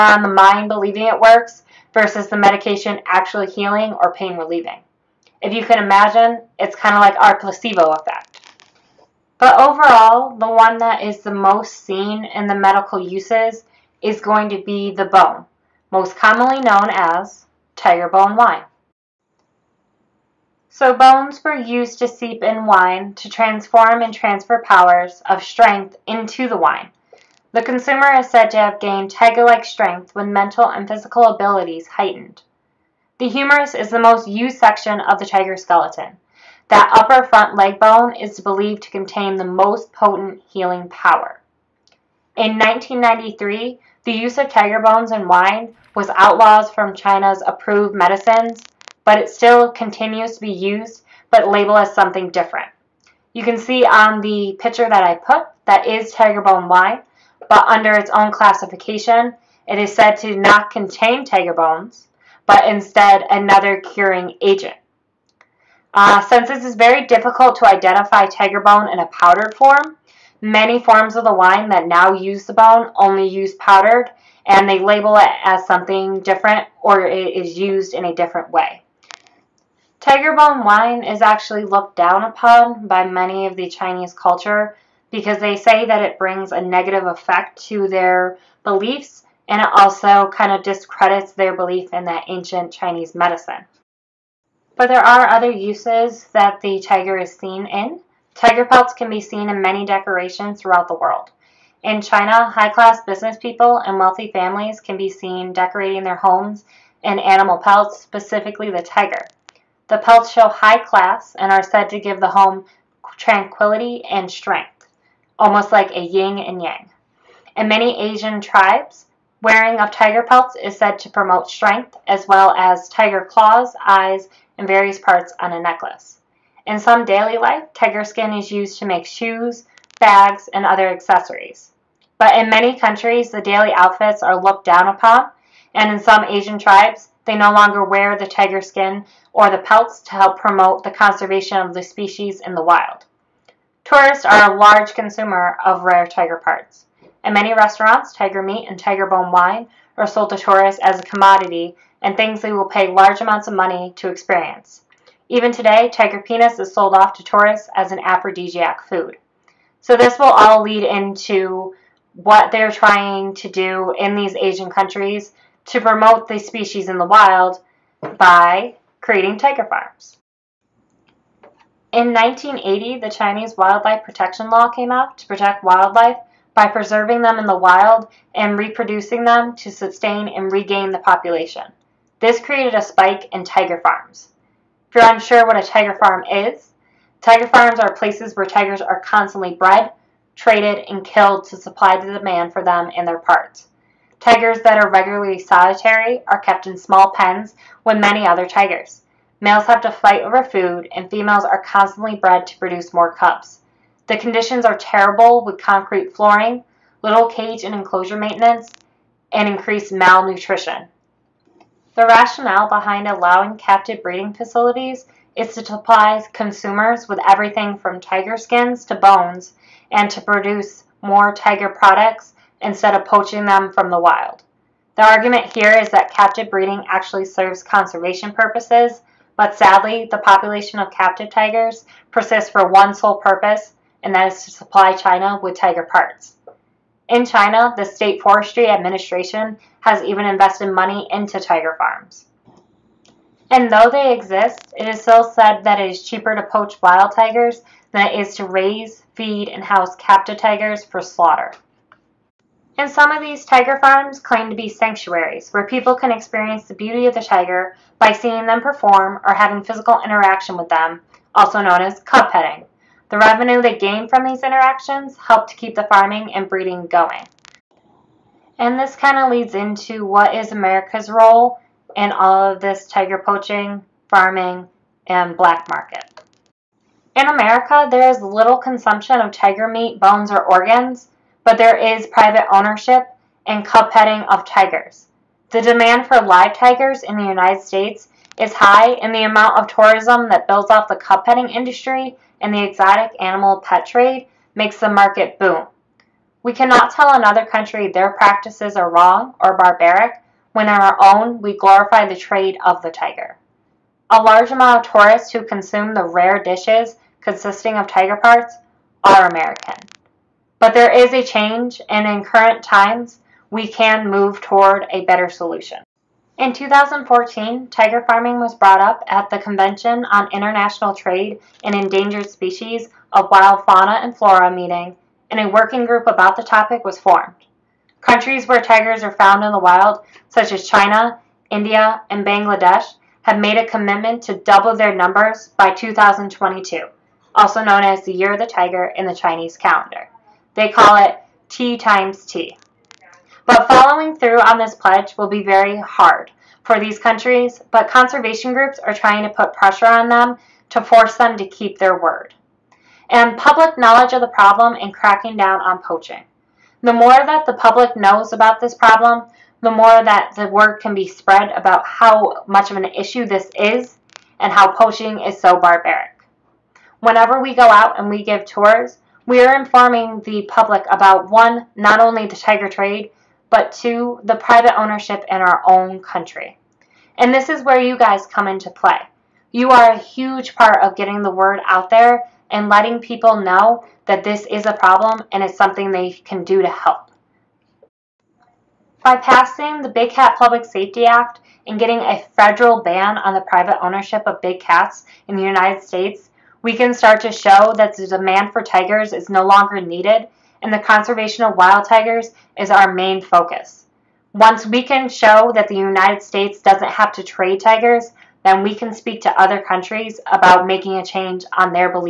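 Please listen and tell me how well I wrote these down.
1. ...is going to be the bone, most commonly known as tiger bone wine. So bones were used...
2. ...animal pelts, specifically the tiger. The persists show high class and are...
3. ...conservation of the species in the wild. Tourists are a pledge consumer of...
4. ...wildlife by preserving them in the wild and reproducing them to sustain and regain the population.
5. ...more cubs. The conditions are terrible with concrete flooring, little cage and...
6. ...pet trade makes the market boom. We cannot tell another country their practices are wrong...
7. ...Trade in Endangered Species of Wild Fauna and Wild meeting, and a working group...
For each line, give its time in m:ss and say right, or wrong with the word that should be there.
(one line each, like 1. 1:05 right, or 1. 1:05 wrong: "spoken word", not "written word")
1. 0:14 right
2. 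1:47 wrong: "pelts", not "persists"
3. 2:20 wrong: "large", not "pledge"
4. 2:55 right
5. 3:22 right
6. 4:53 right
7. 5:20 wrong: "Flora", not "Wild".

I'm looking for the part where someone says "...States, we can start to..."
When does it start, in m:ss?
6:35.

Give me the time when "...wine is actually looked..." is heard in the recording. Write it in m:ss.
1:20.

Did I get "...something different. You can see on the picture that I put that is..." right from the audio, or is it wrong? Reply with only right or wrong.
right.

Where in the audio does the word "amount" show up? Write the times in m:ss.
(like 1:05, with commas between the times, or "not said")
2:33, 4:49, 5:04.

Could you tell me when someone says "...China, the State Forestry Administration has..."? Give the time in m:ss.
3:57.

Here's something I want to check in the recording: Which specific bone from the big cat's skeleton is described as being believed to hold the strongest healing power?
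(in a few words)
Humerus.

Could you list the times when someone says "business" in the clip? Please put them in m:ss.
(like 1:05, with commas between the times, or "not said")
1:43.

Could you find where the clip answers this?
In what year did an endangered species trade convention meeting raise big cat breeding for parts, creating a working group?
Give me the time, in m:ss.
5:16.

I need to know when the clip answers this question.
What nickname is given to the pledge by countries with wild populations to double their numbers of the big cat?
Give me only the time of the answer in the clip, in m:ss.
5:41.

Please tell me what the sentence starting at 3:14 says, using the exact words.
Tigers that are regularly solitary are kept in small pens with many other tigers.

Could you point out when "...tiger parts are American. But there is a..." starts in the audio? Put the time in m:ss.
5:07.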